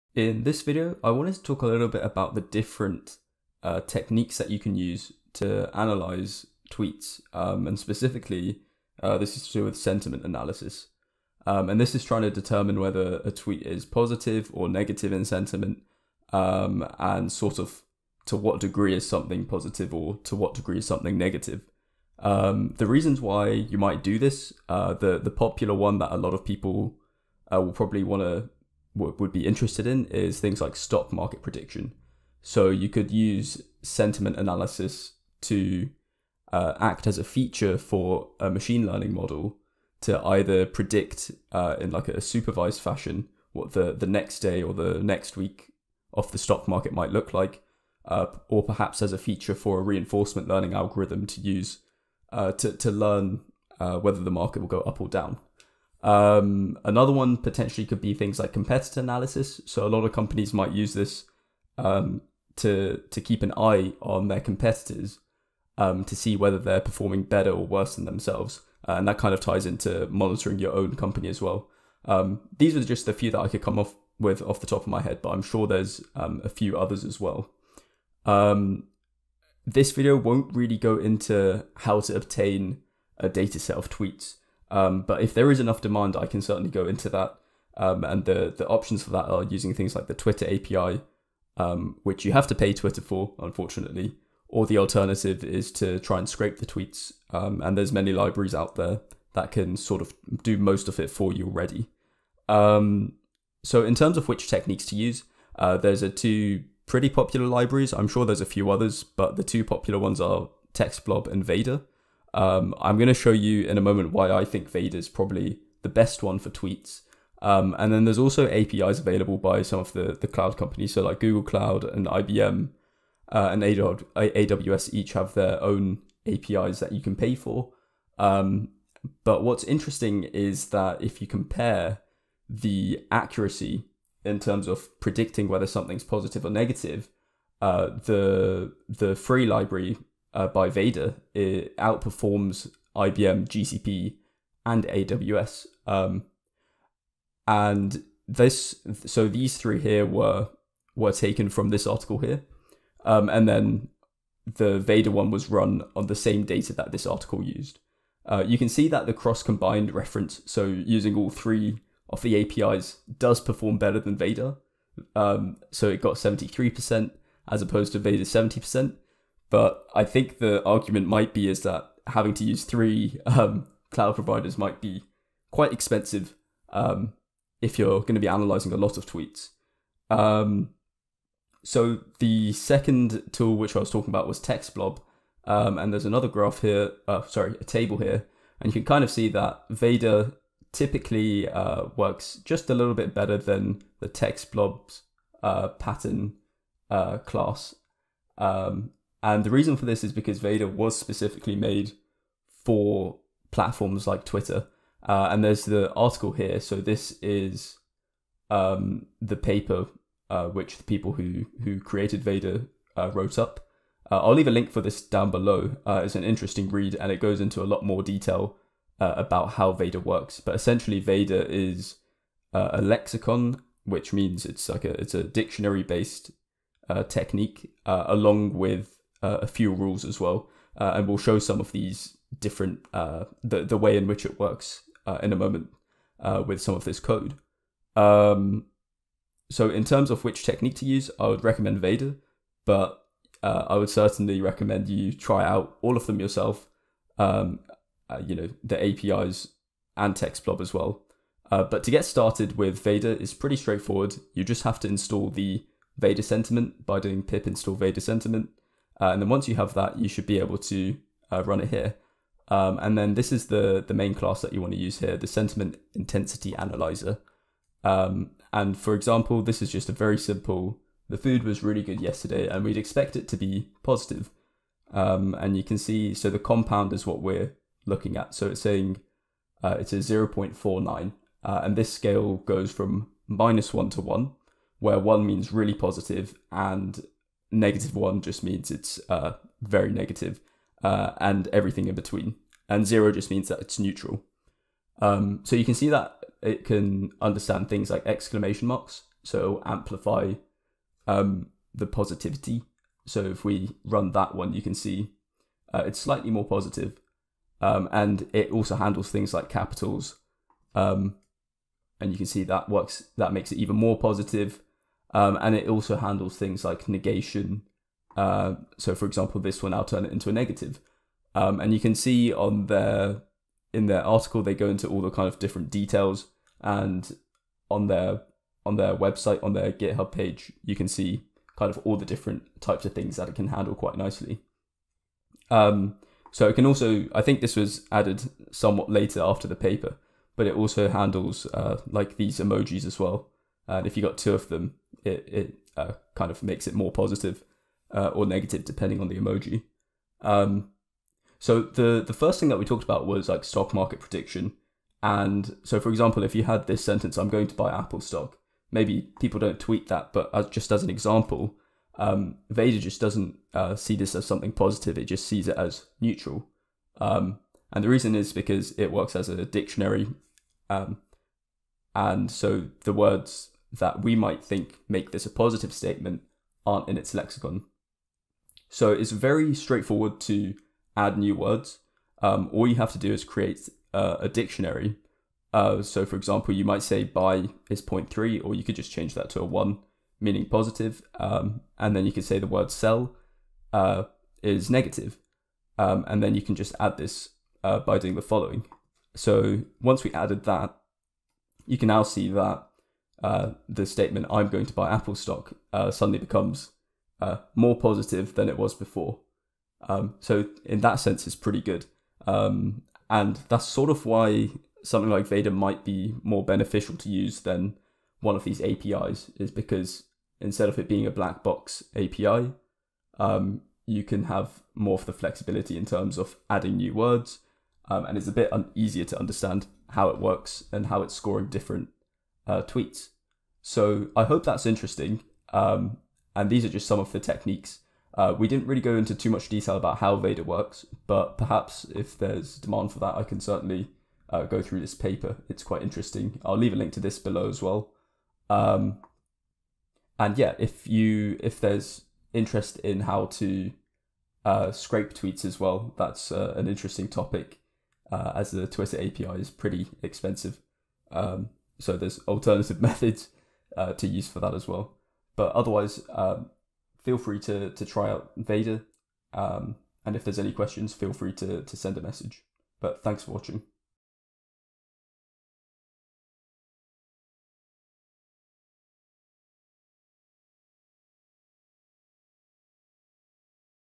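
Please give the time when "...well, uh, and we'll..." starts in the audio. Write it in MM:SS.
03:50.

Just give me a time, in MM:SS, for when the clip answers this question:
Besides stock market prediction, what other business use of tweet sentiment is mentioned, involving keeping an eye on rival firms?
00:58.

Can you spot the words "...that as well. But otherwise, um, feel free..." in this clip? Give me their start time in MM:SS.
07:44.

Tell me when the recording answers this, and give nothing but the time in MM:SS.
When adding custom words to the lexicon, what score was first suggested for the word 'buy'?
06:27.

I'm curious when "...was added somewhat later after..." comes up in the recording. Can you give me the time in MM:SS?
05:37.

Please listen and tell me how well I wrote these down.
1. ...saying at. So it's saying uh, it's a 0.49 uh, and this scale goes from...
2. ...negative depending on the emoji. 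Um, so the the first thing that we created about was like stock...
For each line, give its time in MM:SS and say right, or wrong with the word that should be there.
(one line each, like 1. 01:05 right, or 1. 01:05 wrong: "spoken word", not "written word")
1. 04:37 wrong: "looking", not "saying"
2. 05:48 wrong: "talked", not "created".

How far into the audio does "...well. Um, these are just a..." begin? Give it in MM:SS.
01:11.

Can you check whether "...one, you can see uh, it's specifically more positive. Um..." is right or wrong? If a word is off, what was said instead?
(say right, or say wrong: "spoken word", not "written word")
wrong: "slightly", not "specifically".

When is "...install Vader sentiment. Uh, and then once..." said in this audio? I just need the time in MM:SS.
04:17.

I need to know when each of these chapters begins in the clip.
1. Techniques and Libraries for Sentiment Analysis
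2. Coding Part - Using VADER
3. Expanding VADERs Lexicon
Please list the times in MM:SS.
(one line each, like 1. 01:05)
1. 01:43
2. 04:13
3. 06:00.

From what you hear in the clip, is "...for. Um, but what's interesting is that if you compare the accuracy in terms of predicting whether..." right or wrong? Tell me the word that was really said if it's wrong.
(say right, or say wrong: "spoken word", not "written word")
right.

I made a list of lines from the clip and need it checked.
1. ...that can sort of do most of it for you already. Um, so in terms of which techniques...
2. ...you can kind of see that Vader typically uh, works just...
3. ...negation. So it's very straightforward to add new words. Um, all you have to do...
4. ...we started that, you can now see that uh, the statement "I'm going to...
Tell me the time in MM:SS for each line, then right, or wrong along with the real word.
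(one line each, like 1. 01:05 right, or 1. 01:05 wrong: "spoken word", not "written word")
1. 01:39 right
2. 03:08 right
3. 06:17 wrong: "lexicon", not "negation"
4. 06:40 wrong: "added", not "started".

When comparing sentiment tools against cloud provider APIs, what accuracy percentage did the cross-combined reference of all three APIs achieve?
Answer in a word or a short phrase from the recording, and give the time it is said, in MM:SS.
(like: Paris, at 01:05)
73%, at 02:46.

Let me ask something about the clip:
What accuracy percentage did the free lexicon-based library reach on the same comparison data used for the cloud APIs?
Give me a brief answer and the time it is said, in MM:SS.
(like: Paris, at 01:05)
70%, at 02:48.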